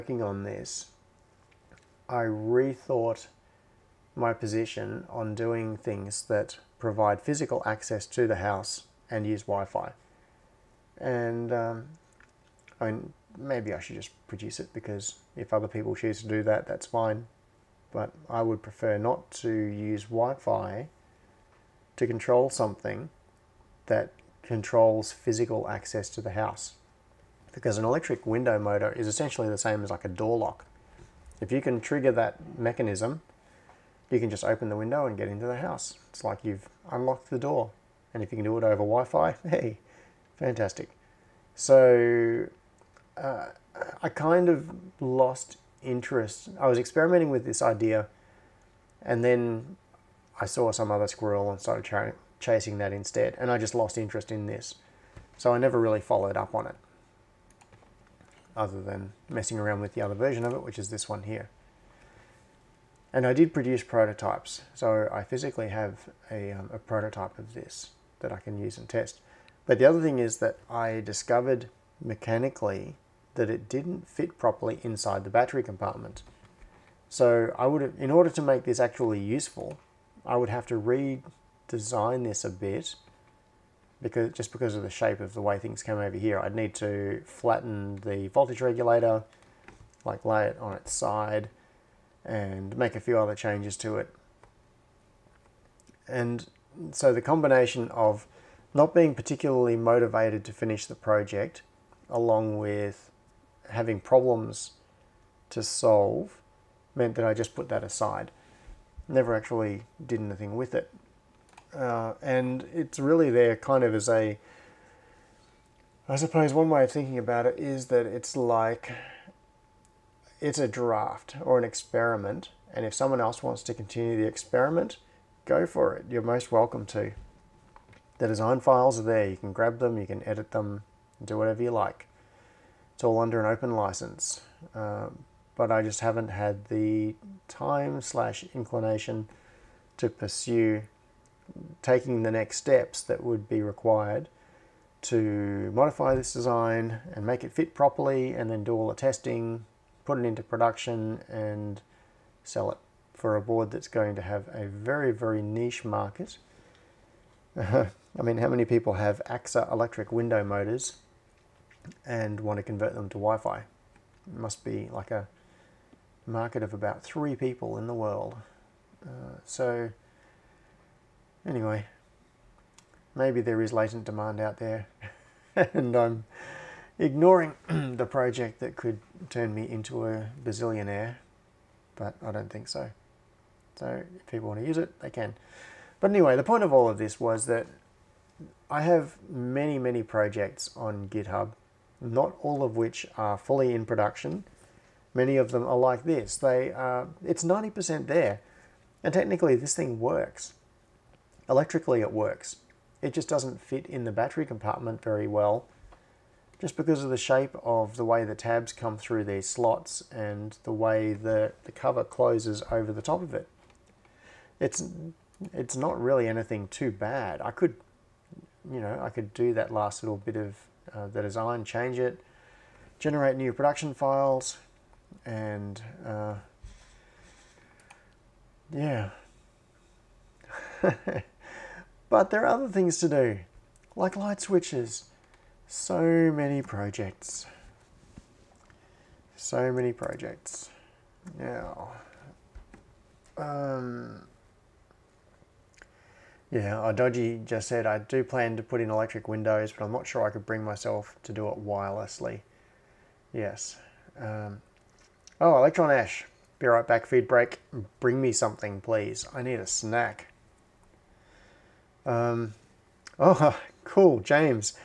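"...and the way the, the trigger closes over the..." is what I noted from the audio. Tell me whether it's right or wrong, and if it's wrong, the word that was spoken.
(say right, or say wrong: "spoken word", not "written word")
wrong: "cover", not "trigger".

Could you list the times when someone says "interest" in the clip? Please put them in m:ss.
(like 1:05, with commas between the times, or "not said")
0:45, 0:53.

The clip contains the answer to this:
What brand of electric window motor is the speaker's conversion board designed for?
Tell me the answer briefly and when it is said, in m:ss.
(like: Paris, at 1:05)
AXA, at 2:39.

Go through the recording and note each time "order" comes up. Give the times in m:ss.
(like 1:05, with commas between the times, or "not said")
1:18.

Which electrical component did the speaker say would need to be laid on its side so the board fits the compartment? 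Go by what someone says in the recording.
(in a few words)
voltage regulator.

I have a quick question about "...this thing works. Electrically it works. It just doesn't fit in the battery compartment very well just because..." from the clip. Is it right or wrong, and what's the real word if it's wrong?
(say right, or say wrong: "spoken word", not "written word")
right.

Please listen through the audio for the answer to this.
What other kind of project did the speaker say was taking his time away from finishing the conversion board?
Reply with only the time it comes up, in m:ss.
3:54.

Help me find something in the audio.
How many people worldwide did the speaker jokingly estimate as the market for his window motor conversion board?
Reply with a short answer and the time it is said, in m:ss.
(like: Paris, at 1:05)
3, at 2:47.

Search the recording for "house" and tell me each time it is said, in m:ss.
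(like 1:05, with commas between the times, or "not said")
0:08, 0:26, 0:35.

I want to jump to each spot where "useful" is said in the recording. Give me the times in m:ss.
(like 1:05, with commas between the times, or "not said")
1:19.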